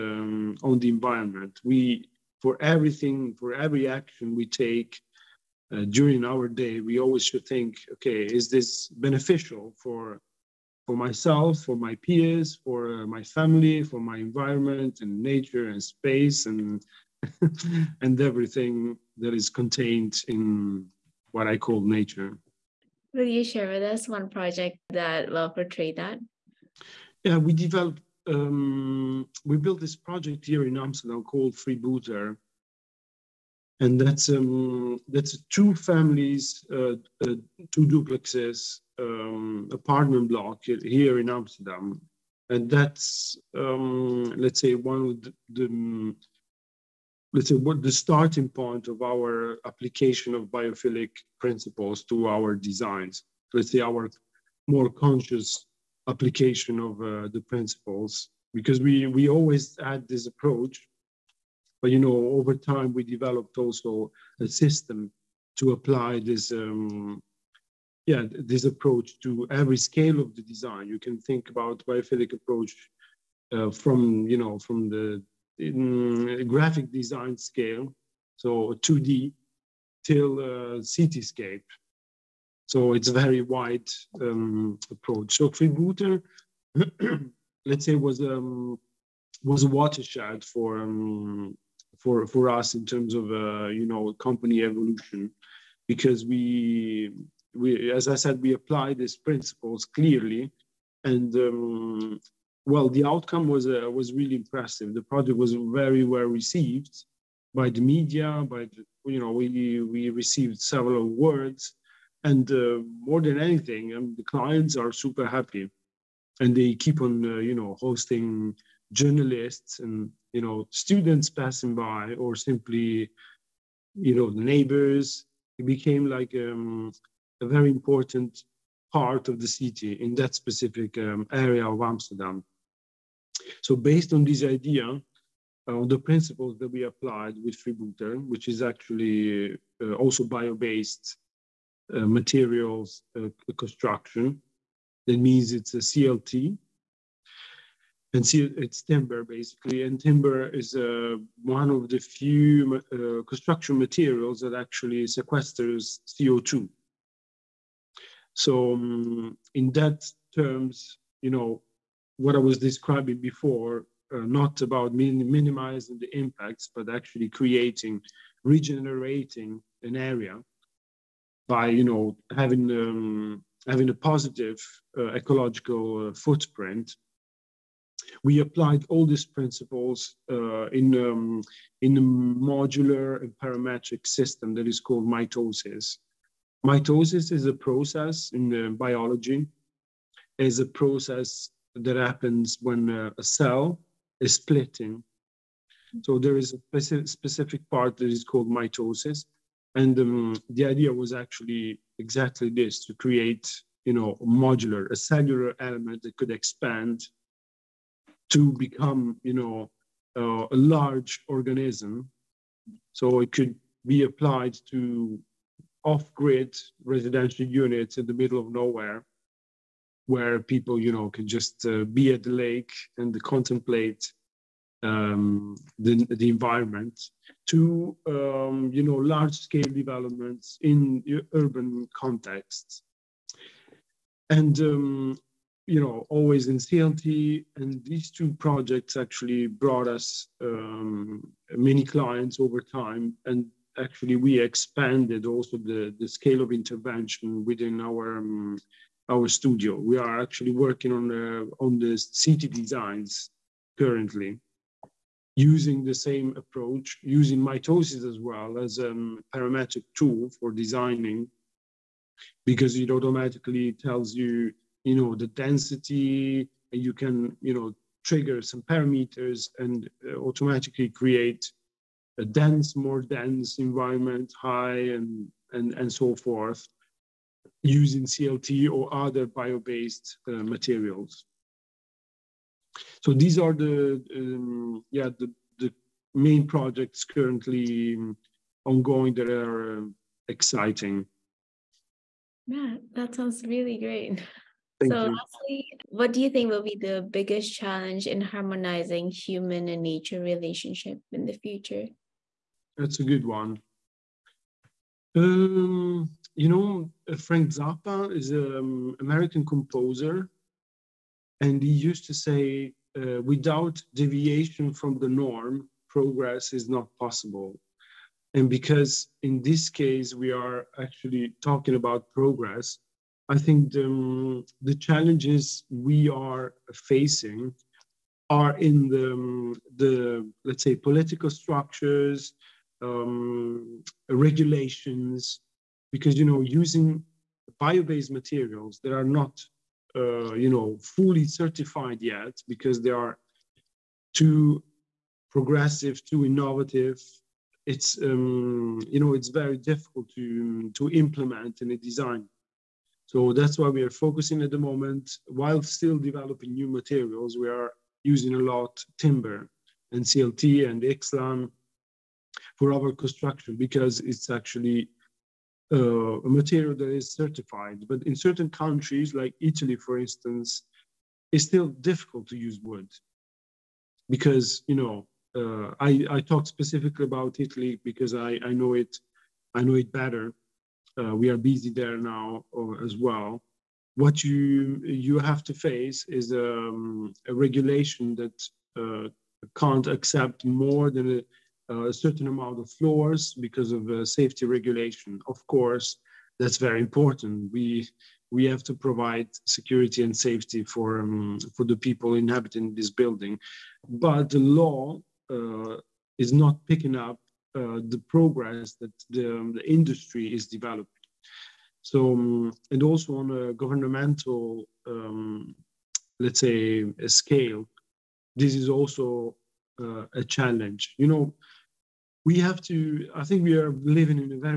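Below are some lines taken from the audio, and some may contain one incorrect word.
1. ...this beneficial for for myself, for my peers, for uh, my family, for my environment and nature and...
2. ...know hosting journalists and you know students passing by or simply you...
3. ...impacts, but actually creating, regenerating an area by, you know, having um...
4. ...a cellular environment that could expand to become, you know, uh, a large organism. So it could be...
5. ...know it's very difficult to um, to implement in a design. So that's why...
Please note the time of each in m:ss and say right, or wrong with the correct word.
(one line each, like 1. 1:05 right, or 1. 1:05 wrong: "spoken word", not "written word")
1. 0:08 right
2. 1:57 right
3. 2:46 right
4. 3:24 wrong: "element", not "environment"
5. 5:48 right.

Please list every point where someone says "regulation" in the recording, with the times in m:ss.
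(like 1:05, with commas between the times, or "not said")
5:34, 6:27, 6:34.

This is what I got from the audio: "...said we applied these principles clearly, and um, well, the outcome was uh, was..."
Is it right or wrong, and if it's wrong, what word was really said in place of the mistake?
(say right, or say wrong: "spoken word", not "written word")
right.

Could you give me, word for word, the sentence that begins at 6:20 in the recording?
Uh, we are busy there now uh, as well.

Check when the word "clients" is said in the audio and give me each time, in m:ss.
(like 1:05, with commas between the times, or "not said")
1:54, 4:01.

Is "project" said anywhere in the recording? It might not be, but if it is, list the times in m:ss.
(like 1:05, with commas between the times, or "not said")
0:24, 0:29, 1:45, 3:58, 4:46.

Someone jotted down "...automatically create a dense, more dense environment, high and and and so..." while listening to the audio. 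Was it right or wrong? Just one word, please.
right.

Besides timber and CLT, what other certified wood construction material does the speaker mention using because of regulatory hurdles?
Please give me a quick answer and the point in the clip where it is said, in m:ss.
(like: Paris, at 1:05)
XLAM, at 6:00.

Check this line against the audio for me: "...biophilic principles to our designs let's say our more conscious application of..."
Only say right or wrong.
right.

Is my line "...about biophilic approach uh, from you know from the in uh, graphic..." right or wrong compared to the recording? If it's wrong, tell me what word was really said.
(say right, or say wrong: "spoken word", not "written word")
right.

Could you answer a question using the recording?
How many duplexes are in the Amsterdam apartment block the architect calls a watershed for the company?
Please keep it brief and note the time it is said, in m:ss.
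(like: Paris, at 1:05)
2, at 0:37.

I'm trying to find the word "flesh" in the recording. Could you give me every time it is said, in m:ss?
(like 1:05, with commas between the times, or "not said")
not said.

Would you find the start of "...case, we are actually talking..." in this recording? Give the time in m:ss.
5:19.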